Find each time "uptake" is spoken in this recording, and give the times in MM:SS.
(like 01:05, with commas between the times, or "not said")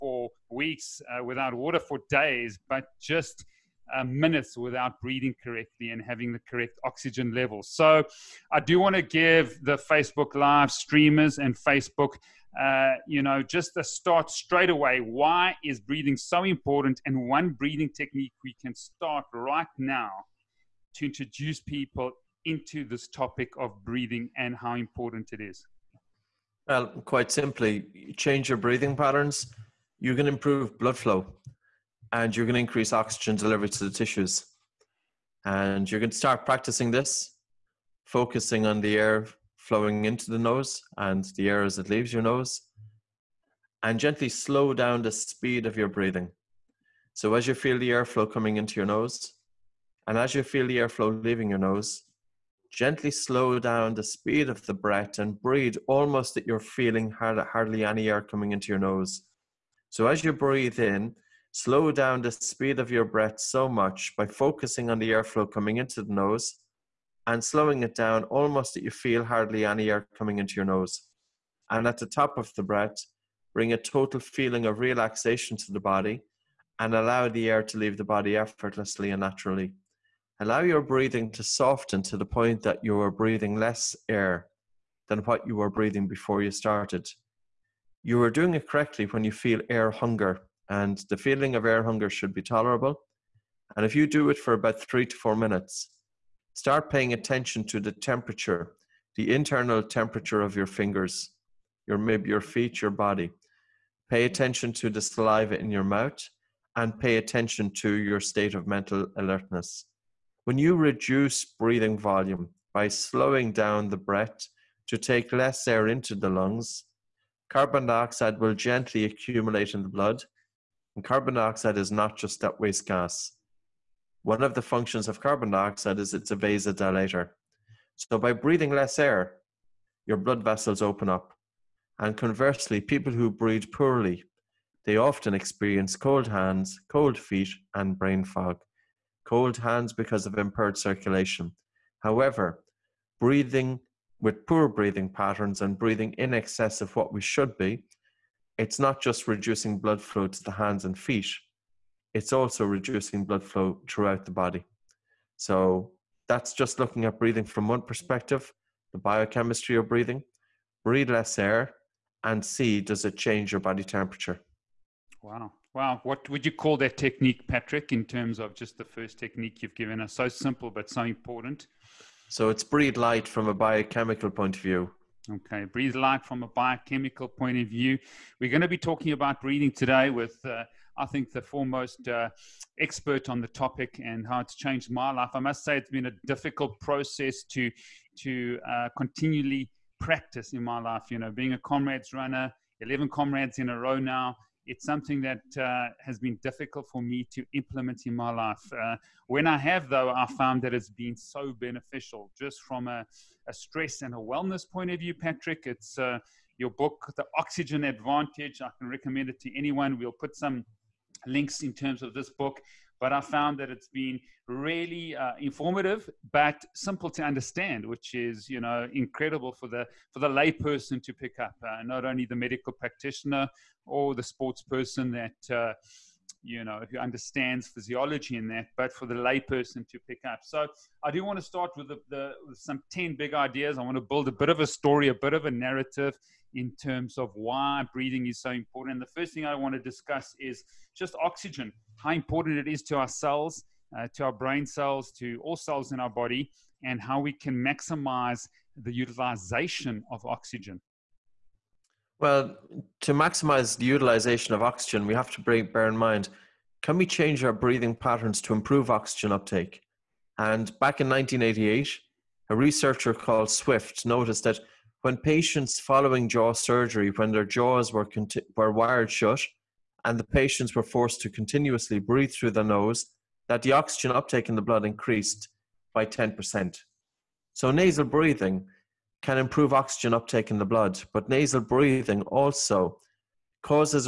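04:19, 04:34, 04:40.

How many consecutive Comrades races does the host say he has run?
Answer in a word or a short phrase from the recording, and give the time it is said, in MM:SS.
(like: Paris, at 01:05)
11, at 03:12.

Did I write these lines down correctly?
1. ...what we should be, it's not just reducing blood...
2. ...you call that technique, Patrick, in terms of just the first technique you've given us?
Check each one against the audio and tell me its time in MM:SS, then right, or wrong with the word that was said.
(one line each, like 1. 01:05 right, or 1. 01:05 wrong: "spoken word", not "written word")
1. 02:26 right
2. 02:46 right.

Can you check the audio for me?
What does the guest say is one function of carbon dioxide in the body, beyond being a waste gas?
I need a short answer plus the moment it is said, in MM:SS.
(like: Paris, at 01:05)
Vasodilator, at 02:06.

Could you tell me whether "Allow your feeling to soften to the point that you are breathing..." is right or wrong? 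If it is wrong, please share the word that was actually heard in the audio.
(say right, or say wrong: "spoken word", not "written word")
wrong: "breathing", not "feeling".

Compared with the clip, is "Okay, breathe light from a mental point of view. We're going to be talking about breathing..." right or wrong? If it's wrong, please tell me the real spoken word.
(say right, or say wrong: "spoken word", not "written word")
wrong: "biochemical", not "mental".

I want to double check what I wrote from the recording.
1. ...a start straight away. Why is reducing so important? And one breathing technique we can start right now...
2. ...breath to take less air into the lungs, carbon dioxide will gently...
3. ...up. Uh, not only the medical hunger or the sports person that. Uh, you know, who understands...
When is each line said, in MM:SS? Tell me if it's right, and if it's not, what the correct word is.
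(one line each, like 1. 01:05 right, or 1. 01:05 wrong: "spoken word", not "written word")
1. 00:13 wrong: "breathing", not "reducing"
2. 01:53 right
3. 03:41 wrong: "practitioner", not "hunger".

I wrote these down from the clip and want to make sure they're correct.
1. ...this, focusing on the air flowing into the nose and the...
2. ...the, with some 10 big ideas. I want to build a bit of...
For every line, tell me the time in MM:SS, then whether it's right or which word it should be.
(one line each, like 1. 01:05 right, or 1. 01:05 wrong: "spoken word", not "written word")
1. 00:36 right
2. 03:52 right.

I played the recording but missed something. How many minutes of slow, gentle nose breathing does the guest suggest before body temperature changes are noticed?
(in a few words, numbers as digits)
3 to 4 minutes.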